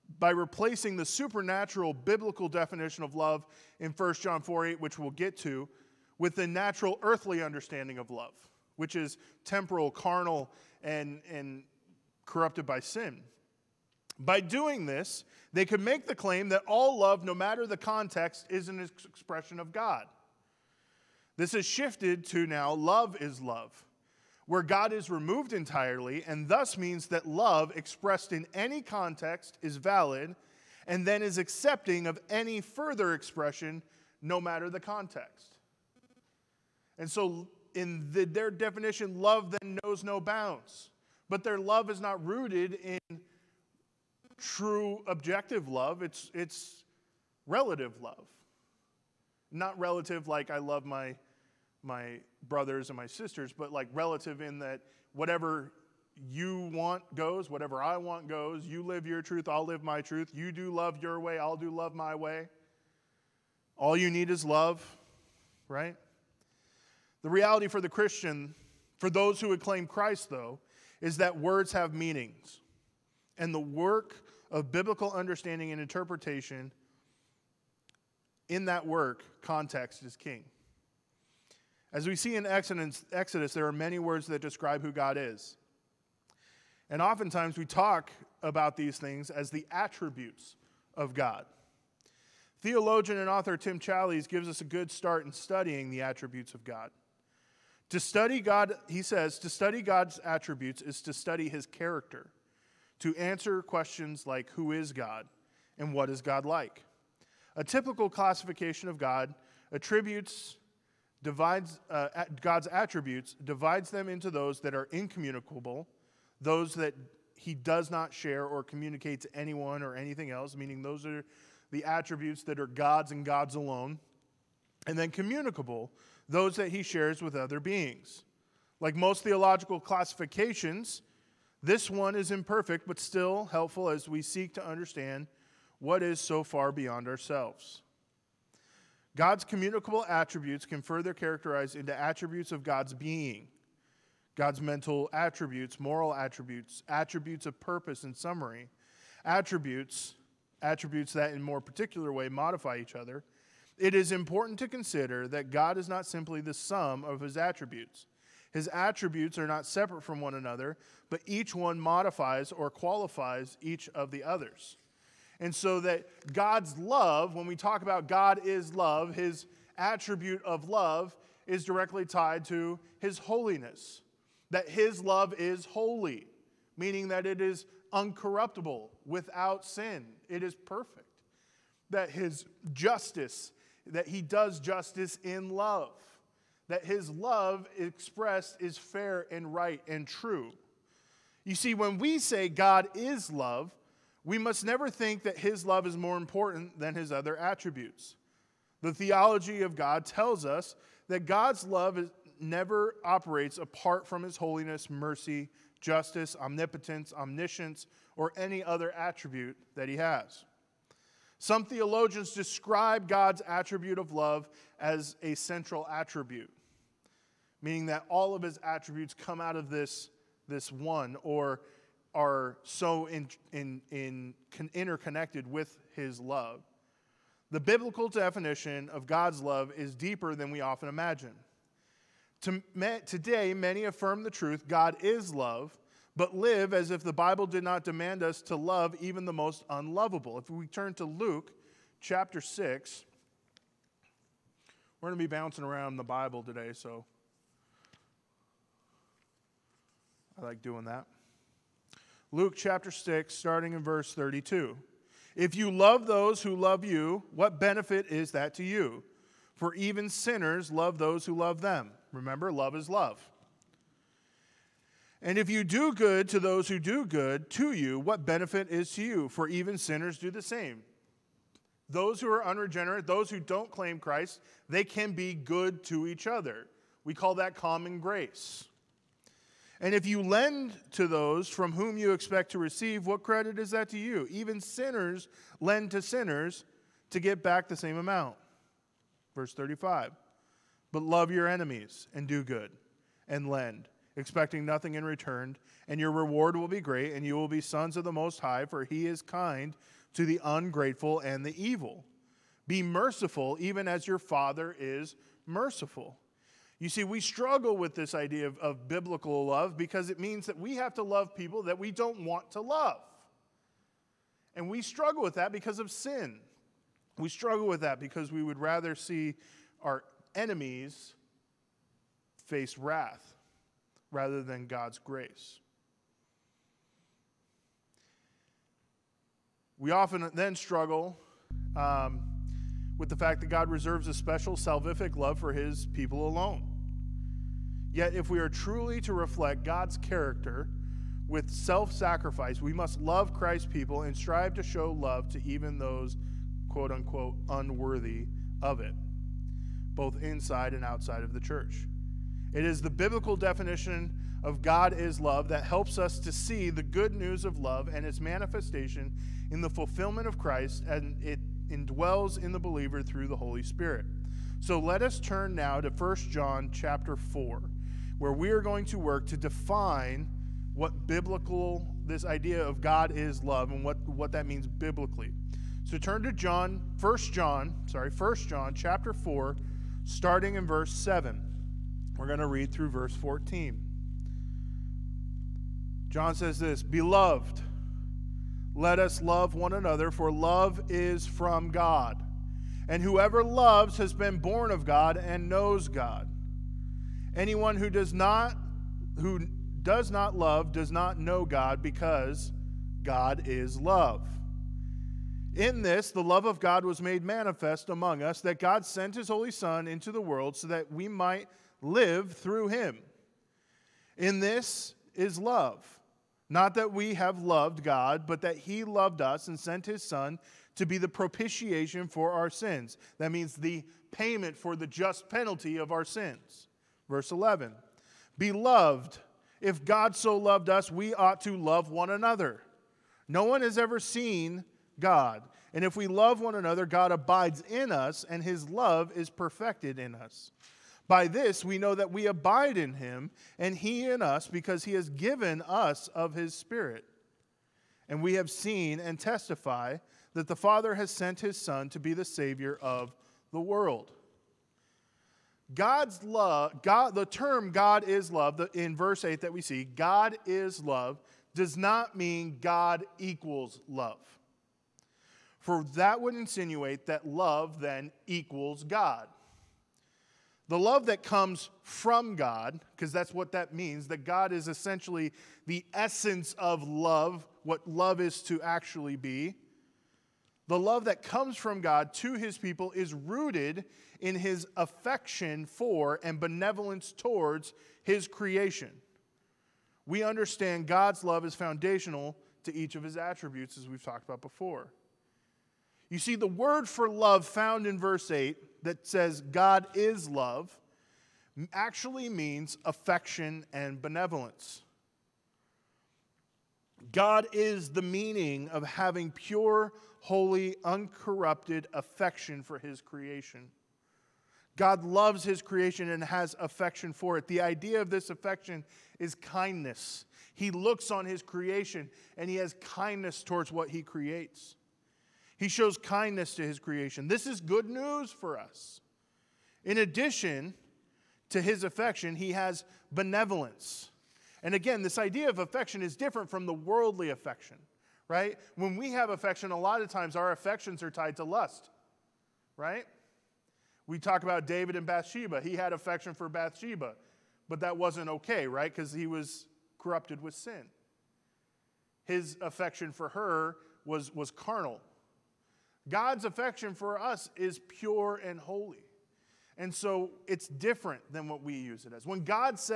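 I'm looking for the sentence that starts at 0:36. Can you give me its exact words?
And so, in the, their definition, love then knows no bounds.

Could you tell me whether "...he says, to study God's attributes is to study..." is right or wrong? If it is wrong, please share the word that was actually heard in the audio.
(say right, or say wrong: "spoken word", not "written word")
right.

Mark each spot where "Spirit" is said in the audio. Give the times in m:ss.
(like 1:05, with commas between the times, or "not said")
6:03, 7:26.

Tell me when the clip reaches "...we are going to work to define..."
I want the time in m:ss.
6:08.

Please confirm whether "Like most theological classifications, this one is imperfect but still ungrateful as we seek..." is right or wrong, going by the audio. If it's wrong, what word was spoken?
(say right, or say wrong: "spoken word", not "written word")
wrong: "helpful", not "ungrateful".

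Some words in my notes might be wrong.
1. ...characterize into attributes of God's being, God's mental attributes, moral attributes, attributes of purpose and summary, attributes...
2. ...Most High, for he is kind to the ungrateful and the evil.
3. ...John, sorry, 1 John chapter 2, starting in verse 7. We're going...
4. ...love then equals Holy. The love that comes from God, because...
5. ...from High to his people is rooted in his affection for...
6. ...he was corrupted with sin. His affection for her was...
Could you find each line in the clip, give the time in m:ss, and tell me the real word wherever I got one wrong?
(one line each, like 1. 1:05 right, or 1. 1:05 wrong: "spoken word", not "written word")
1. 2:21 right
2. 4:58 right
3. 6:17 wrong: "4", not "2"
4. 7:47 wrong: "God", not "Holy"
5. 8:01 wrong: "God", not "High"
6. 9:09 right.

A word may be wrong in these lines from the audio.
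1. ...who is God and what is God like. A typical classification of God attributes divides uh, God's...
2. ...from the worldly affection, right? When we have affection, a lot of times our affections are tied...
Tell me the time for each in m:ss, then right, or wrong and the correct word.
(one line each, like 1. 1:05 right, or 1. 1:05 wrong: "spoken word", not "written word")
1. 1:44 right
2. 8:56 right.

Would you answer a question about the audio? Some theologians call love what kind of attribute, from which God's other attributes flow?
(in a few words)
central attribute.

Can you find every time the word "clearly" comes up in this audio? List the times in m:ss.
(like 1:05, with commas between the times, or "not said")
not said.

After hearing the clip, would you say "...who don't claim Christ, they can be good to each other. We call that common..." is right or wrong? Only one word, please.
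right.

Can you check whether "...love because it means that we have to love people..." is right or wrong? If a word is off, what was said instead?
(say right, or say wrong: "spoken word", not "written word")
right.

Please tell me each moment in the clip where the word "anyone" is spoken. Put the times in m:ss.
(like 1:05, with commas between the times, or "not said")
1:59, 6:37.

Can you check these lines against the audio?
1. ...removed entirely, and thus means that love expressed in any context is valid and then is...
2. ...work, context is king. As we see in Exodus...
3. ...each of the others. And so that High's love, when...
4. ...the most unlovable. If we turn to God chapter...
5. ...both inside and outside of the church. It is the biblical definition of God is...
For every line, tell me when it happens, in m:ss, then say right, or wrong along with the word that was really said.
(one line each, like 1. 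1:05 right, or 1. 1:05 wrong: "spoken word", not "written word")
1. 0:25 right
2. 1:18 right
3. 2:43 wrong: "God", not "High"
4. 3:59 wrong: "Luke", not "God"
5. 5:49 right.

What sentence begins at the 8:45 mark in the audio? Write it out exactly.
He shows kindness to his creation.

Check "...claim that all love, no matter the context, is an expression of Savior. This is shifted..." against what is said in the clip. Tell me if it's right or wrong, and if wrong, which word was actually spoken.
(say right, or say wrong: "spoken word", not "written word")
wrong: "God", not "Savior".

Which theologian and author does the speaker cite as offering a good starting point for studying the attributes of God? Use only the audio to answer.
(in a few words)
Tim Challies.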